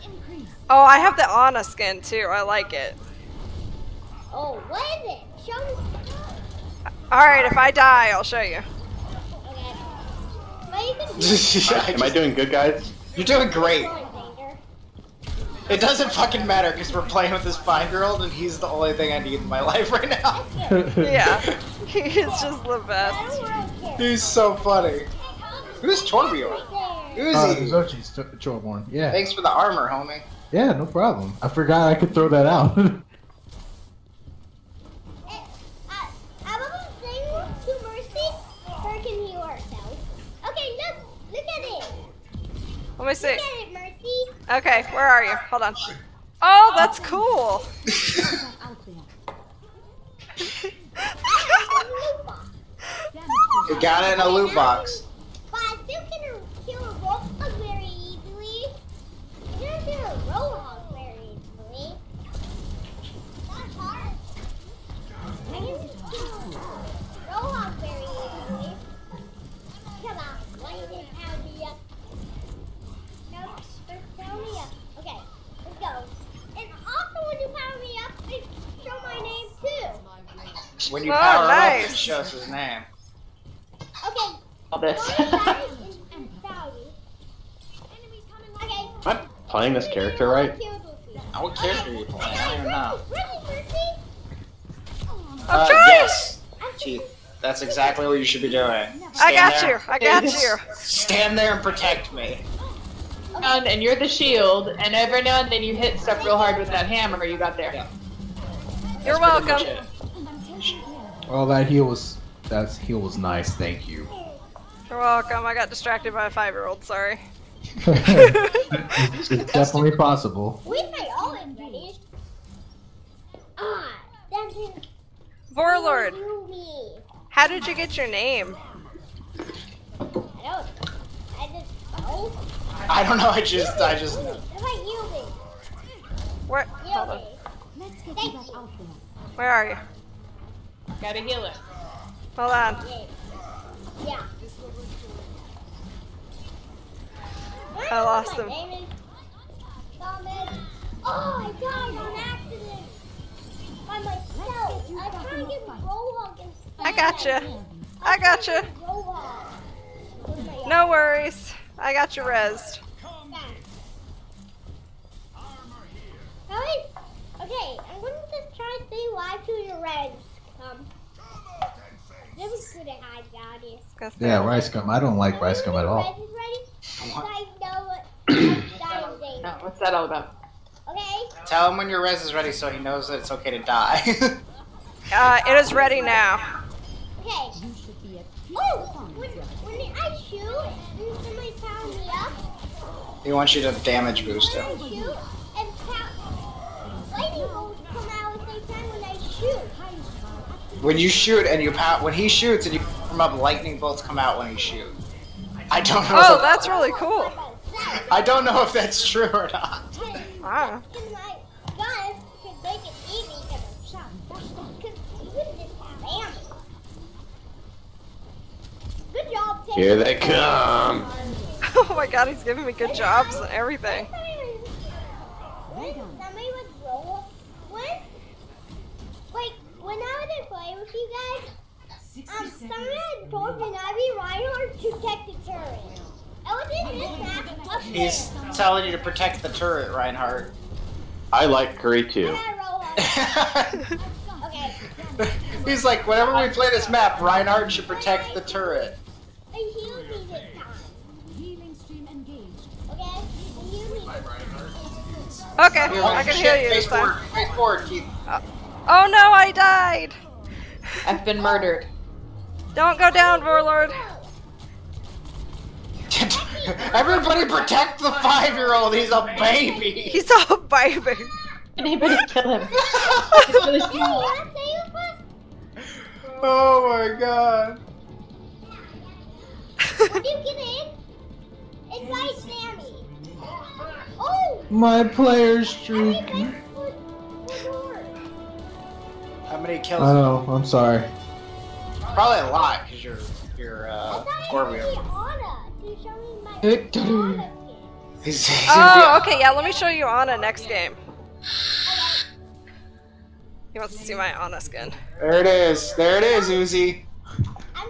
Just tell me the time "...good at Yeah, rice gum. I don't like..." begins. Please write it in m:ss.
2:52.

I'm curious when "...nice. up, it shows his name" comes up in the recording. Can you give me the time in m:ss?
1:21.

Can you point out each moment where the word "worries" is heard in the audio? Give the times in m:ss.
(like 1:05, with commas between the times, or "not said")
2:40.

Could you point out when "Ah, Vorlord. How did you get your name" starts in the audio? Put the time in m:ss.
2:03.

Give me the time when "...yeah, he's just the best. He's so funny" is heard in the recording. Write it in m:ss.
0:20.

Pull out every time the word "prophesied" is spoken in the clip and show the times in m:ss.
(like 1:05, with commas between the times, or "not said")
not said.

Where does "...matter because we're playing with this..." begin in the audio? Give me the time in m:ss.
0:16.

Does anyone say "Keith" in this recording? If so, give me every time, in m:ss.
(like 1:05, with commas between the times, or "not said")
1:36, 4:17.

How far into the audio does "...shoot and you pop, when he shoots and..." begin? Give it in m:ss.
3:21.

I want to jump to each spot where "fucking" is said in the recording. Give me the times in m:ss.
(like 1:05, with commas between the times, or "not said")
0:16.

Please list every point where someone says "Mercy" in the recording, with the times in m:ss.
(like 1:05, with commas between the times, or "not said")
0:43.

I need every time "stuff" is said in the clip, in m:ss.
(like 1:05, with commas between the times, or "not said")
1:45.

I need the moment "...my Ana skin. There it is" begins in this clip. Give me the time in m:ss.
5:04.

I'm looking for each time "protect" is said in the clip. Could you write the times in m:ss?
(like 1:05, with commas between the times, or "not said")
1:41, 3:54, 3:58, 4:07, 4:27.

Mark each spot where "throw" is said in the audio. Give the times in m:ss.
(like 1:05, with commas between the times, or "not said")
0:32.